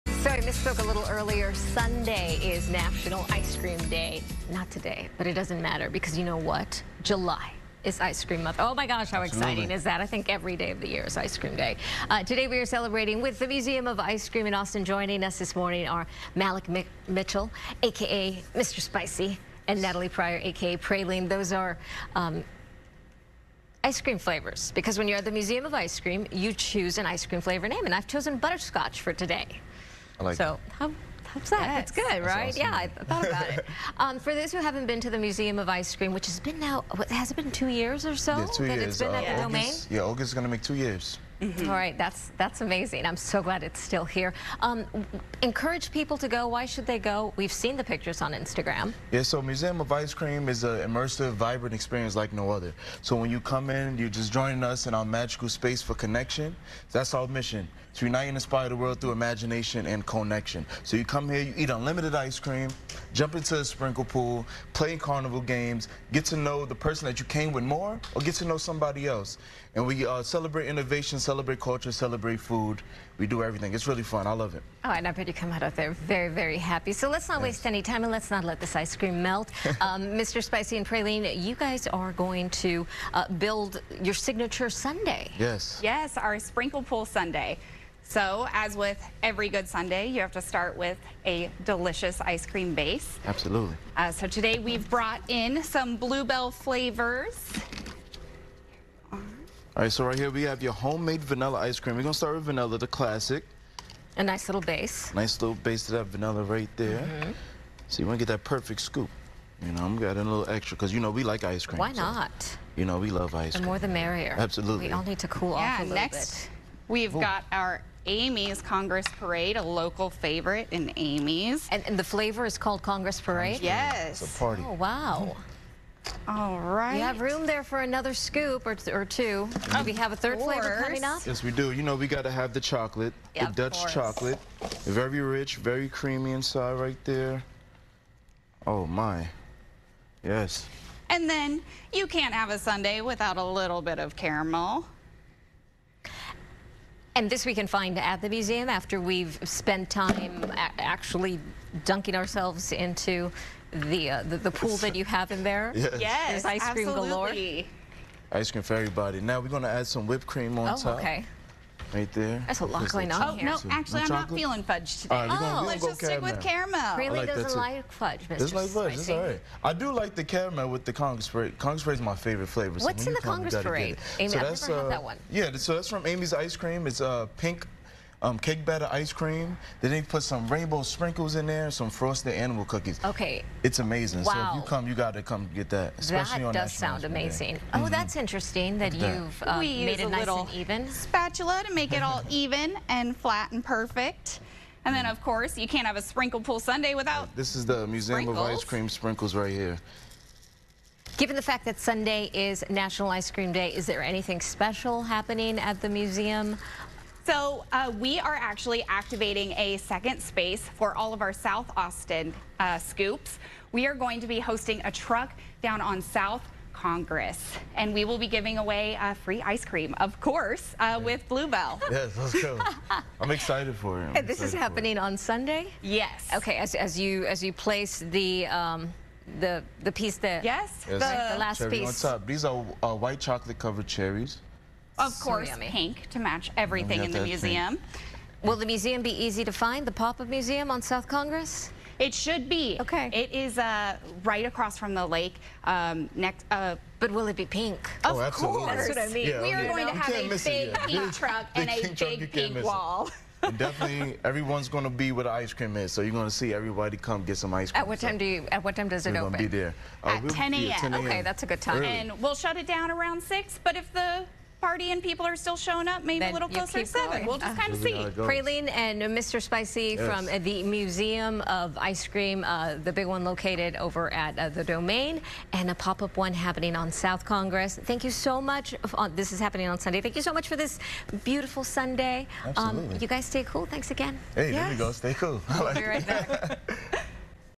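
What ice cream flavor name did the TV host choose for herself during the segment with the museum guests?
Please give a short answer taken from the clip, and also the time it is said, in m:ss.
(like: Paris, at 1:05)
Butterscotch, at 0:28.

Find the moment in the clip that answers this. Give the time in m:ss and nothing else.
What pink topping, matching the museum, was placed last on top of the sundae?
3:52.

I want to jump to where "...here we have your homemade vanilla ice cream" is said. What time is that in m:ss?
1:40.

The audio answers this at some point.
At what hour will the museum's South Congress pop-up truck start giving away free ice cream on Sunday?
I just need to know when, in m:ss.
4:20.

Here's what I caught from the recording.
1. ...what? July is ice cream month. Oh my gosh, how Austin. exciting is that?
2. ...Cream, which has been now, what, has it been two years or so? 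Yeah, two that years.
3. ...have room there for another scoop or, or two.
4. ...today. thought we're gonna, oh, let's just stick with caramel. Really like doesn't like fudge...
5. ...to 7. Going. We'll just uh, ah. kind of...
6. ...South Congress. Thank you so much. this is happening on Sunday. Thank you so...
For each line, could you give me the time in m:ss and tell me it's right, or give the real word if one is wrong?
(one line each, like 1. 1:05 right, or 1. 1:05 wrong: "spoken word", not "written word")
1. 0:06 wrong: "Absolutely", not "Austin"
2. 0:35 right
3. 2:07 right
4. 2:45 wrong: "alright", not "thought"
5. 4:26 right
6. 4:36 right.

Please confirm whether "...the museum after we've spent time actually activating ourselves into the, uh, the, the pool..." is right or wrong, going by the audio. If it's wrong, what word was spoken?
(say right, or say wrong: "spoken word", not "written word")
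wrong: "dunking", not "activating".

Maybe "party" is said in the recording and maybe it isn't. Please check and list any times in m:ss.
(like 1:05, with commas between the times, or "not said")
2:04, 4:24.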